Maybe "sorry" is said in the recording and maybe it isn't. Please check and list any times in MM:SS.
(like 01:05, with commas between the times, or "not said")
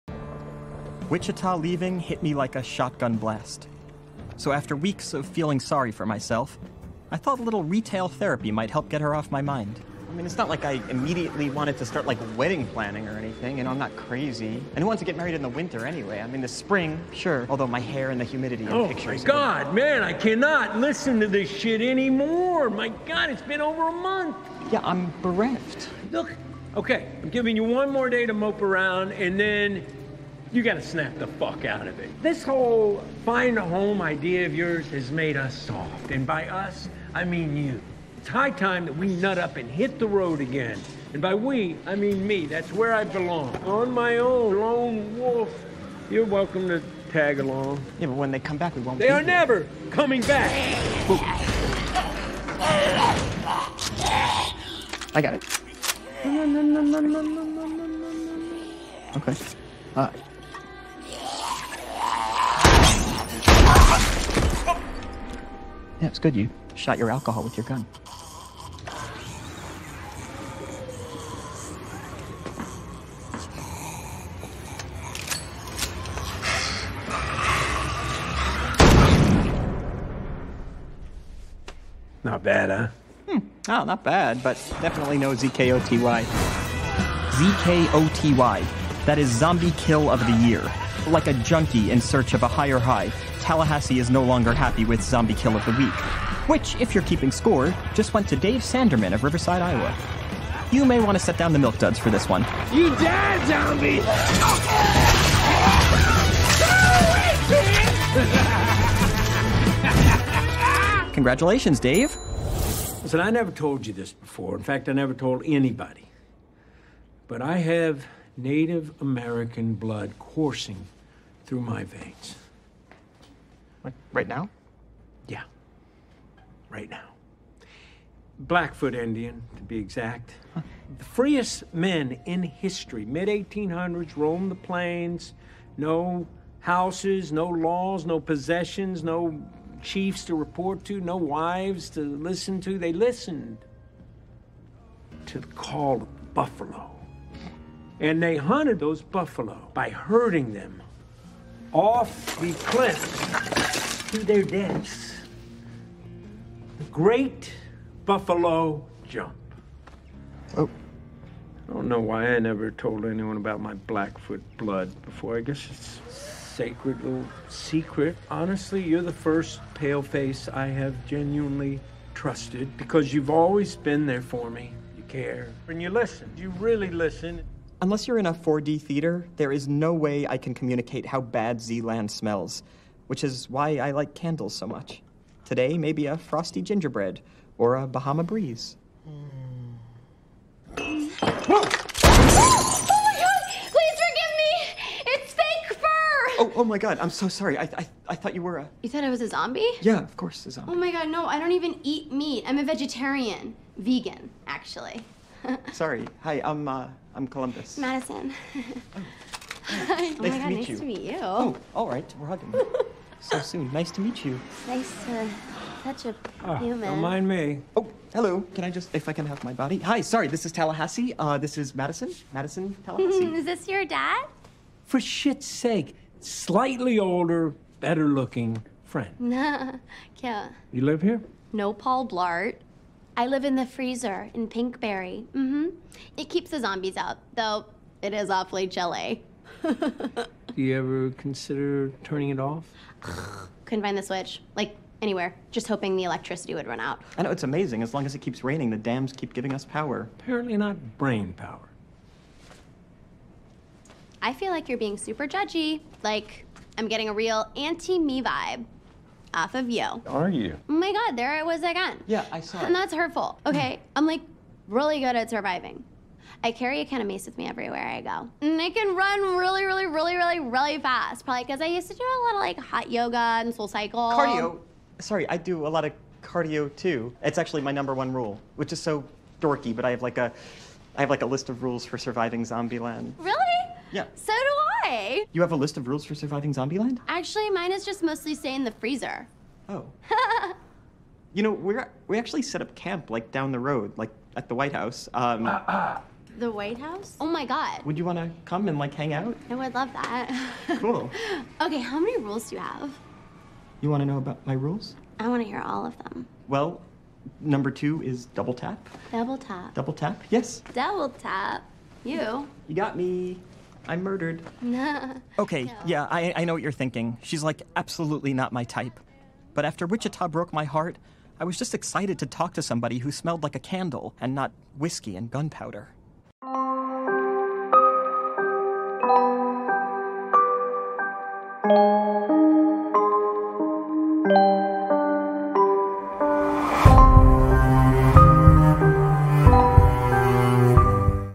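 00:05, 03:17, 03:25, 03:40, 04:34.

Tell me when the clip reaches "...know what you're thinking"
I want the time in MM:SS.
05:16.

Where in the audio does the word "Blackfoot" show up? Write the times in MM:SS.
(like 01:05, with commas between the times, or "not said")
02:08, 02:43.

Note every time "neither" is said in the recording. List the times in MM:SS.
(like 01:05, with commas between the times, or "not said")
not said.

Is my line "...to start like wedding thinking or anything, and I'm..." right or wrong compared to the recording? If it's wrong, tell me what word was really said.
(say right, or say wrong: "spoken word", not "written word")
wrong: "planning", not "thinking".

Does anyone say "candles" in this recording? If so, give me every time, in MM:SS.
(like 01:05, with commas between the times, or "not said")
03:04, 05:23.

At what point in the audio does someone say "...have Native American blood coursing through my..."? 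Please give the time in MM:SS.
01:57.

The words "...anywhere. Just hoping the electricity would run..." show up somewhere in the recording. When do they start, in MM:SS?
04:05.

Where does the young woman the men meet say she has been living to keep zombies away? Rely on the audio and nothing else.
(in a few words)
The freezer in Pinkberry.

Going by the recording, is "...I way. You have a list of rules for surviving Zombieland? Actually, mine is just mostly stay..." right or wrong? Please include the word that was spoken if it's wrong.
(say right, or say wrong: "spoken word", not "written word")
right.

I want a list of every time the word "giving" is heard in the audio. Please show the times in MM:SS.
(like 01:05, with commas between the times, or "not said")
00:27, 04:09.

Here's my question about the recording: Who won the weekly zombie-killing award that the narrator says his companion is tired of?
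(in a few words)
Dave Sanderman.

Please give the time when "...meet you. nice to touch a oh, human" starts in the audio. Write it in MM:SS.
03:34.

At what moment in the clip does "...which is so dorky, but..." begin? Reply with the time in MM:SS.
04:38.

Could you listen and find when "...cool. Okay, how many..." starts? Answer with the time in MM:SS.
05:00.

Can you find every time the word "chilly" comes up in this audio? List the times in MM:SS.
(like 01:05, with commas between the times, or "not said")
03:58.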